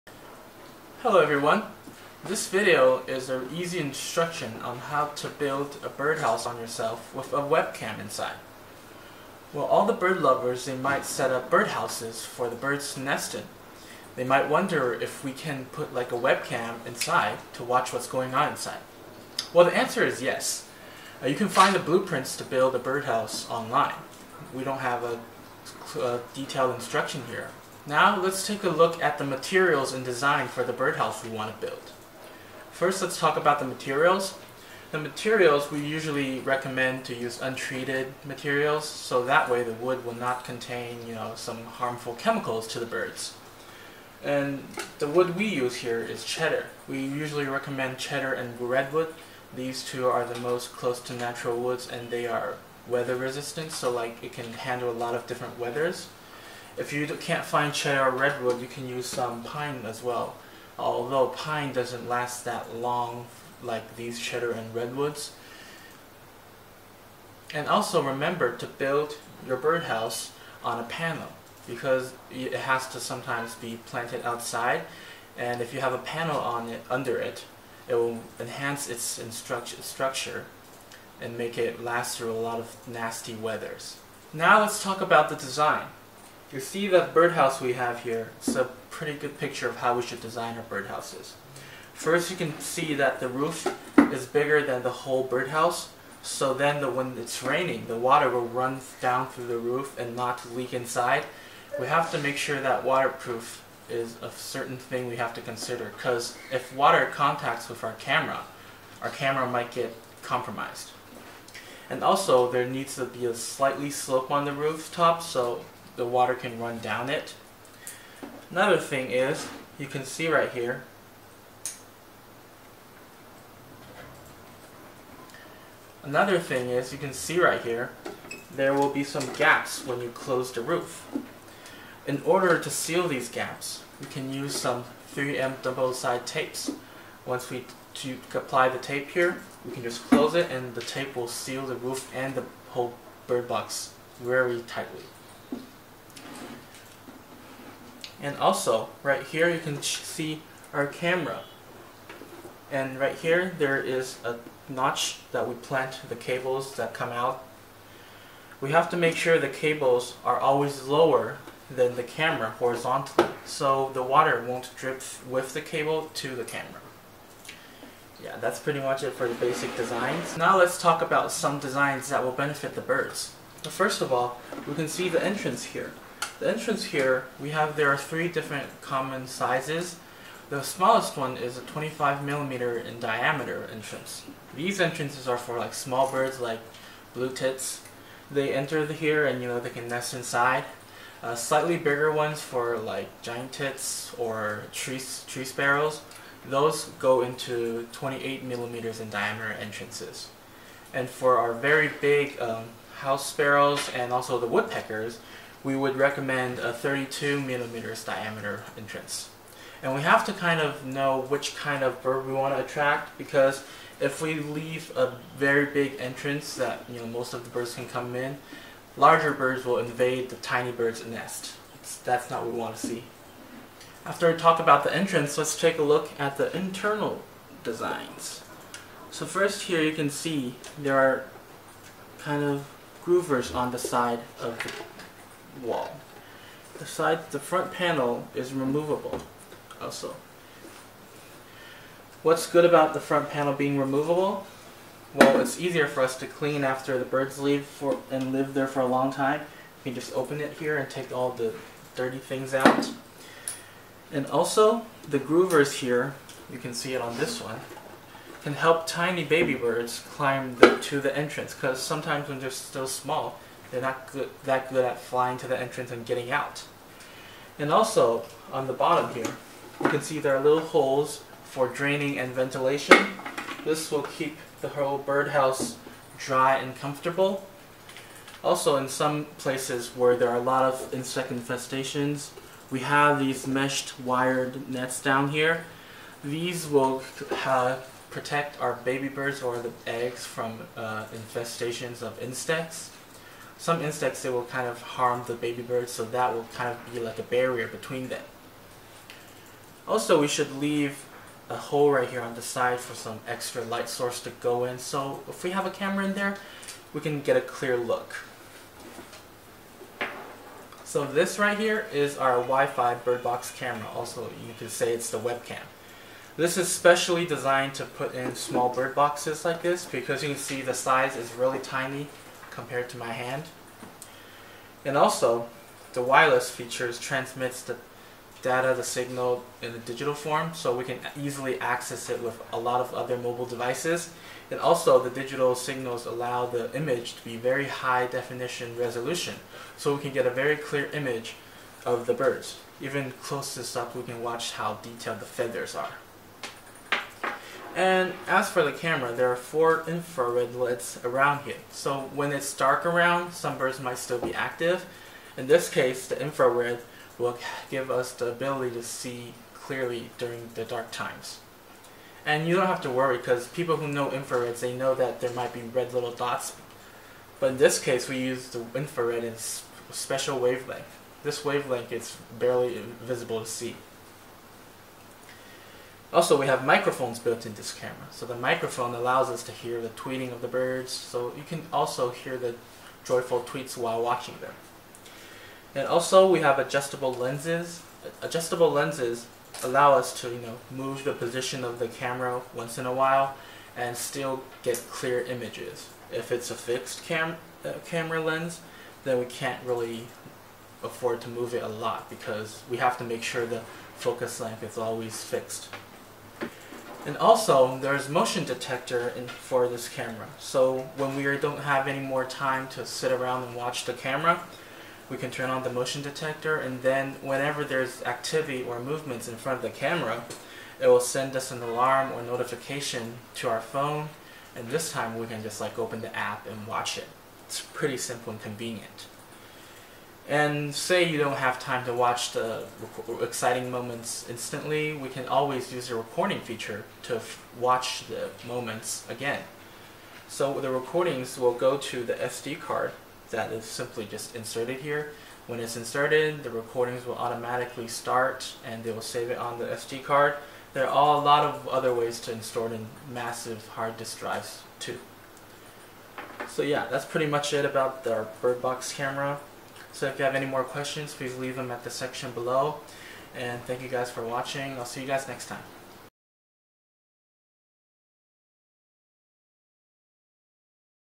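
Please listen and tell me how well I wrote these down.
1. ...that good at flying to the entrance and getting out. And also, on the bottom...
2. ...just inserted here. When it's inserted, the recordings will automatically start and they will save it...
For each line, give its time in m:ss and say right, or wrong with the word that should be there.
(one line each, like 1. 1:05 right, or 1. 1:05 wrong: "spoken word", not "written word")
1. 4:24 right
2. 7:24 right.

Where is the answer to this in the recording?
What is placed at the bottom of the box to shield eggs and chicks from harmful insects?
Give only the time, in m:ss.
4:43.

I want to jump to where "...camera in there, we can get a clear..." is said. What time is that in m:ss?
5:05.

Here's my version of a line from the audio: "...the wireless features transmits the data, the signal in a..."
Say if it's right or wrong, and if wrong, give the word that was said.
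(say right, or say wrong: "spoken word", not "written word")
right.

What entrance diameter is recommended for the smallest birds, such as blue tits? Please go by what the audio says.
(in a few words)
25 millimeters.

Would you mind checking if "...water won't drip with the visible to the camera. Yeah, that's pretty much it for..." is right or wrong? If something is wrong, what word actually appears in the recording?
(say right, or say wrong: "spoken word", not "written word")
wrong: "cable", not "visible".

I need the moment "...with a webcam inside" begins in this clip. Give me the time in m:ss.
0:07.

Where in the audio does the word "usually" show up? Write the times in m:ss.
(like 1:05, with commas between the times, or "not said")
0:35, 0:46.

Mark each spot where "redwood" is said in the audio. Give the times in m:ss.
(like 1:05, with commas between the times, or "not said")
0:48, 0:58, 1:04.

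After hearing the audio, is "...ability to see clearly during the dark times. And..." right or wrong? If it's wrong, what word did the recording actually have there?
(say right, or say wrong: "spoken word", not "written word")
right.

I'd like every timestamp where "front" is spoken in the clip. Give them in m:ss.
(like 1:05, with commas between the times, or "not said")
3:57, 4:02, 6:59.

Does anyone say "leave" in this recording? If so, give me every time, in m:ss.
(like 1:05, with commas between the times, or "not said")
3:34, 4:07, 5:00, 7:41.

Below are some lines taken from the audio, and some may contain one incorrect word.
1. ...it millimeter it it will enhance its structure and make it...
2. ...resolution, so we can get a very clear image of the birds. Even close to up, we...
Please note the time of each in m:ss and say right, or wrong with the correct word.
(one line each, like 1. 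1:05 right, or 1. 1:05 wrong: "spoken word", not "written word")
1. 1:16 wrong: "under", not "millimeter"
2. 5:38 right.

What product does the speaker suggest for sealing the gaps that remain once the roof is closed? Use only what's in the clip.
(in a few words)
3M double side tapes.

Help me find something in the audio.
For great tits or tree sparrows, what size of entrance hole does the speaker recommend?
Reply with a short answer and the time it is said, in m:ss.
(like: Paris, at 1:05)
28 millimeters, at 3:17.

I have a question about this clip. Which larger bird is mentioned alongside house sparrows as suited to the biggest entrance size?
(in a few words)
woodpeckers.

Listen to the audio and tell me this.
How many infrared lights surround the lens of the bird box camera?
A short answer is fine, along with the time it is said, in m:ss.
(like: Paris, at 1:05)
4, at 5:49.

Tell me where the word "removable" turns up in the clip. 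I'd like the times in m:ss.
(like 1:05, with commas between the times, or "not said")
3:58, 4:03.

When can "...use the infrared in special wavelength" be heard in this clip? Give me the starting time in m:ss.
6:08.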